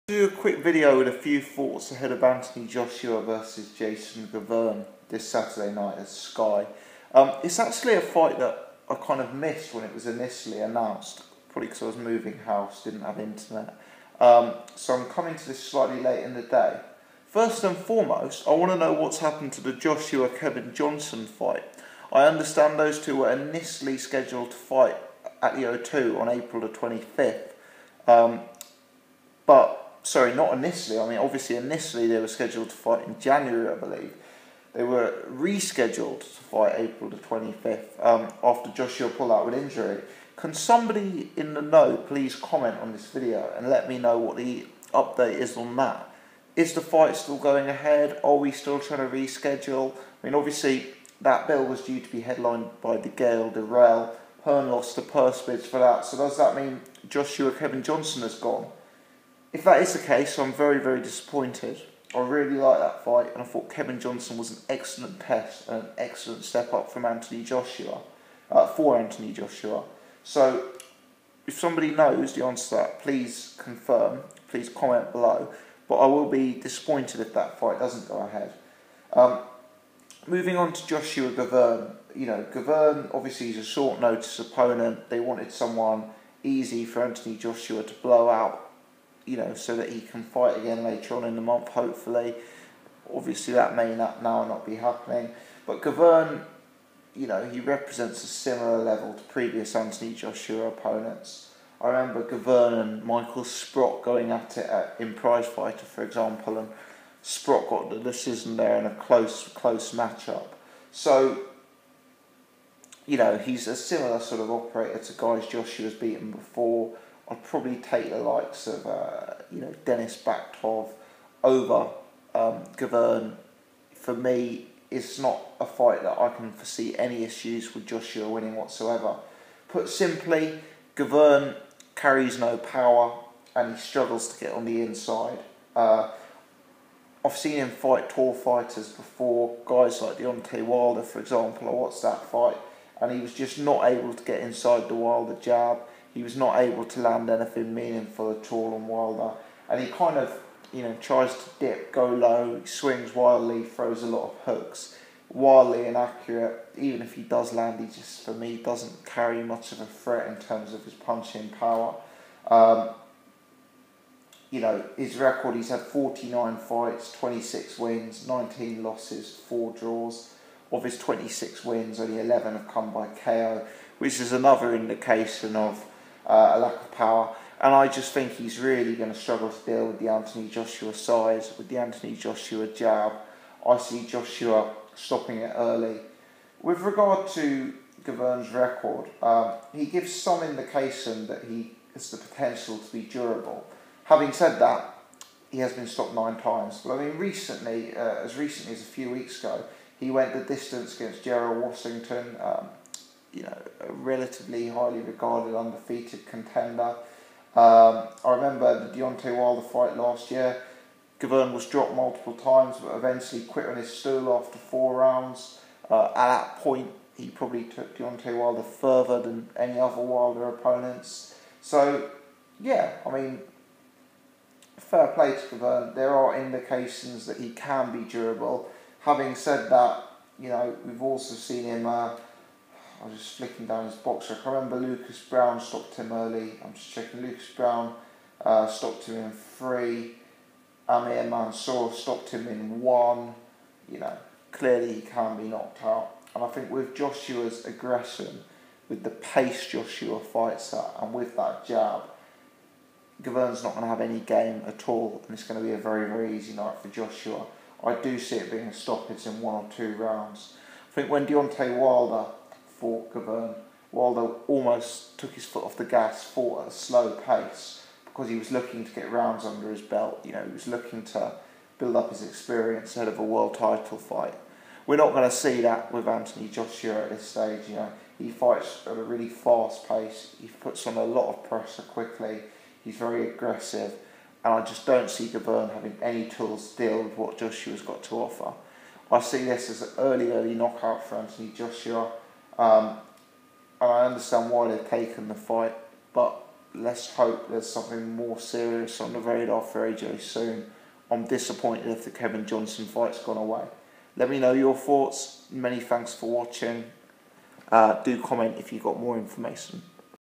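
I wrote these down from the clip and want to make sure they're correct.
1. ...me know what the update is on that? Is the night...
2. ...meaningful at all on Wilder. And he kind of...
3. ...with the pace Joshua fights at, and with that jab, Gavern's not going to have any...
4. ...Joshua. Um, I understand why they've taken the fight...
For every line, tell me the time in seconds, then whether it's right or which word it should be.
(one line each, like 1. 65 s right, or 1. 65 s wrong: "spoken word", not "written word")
1. 43 s wrong: "fight", not "night"
2. 147 s right
3. 248 s right
4. 291 s right.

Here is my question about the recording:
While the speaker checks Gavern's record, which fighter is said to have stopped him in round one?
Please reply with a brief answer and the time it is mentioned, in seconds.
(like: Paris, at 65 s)
Amir Mansour, at 240 s.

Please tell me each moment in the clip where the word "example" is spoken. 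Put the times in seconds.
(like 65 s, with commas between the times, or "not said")
106 s, 141 s.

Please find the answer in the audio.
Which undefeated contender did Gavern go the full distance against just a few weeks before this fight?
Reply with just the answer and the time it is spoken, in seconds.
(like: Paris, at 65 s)
Gerald Washington, at 201 s.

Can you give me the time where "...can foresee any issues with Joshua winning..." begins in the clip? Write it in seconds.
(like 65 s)
126 s.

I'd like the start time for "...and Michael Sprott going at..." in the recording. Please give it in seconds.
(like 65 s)
102 s.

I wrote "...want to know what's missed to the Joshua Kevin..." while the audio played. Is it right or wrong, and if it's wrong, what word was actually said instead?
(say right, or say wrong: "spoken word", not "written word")
wrong: "happened", not "missed".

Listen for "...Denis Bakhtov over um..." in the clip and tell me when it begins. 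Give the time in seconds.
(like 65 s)
119 s.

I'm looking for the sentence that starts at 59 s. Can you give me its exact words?
if that is the case, I'm very, very disappointed.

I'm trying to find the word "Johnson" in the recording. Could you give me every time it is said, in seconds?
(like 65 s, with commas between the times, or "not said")
20 s, 57 s, 63 s, 302 s.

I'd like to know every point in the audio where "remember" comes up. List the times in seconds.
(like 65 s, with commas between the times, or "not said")
101 s, 208 s, 234 s.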